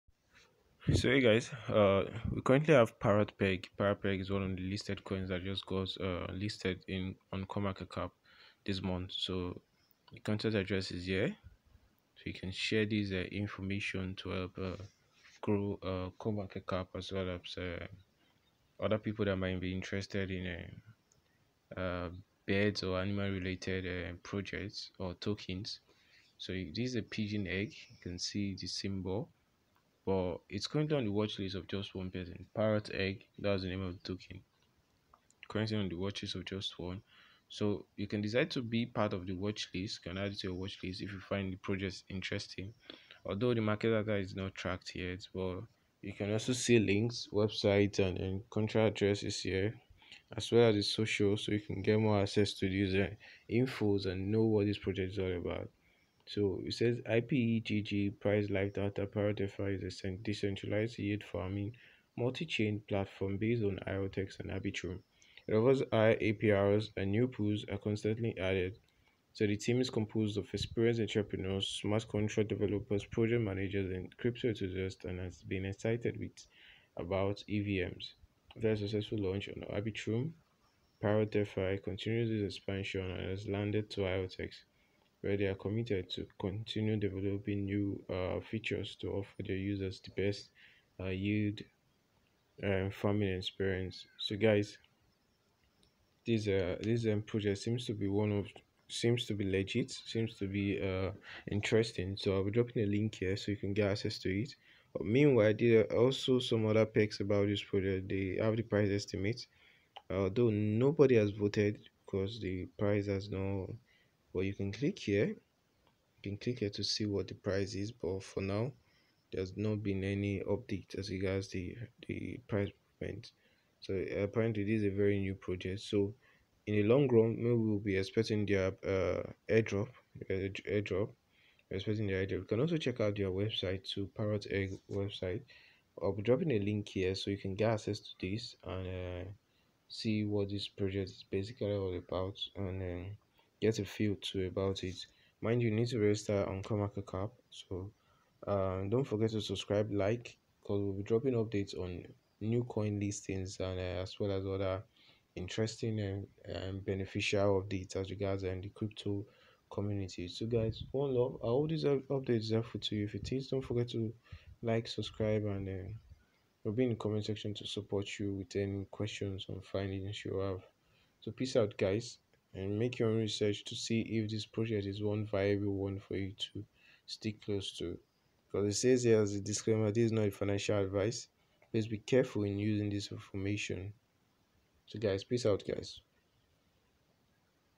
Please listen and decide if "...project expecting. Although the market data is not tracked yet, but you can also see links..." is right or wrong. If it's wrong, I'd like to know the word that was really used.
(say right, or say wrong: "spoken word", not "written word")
wrong: "interesting", not "expecting".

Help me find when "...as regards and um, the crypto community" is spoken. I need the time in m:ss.
2:37.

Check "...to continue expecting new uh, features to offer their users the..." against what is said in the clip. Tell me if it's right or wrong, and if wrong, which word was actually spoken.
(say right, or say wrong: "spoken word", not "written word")
wrong: "developing", not "expecting".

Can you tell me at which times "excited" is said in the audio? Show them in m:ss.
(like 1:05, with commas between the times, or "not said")
1:15.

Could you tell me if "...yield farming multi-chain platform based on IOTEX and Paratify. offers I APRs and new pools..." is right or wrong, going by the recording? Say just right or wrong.
wrong.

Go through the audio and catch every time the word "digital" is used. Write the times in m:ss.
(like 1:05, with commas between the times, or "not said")
not said.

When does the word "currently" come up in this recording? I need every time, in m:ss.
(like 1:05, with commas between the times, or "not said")
0:02, 0:30, 0:35.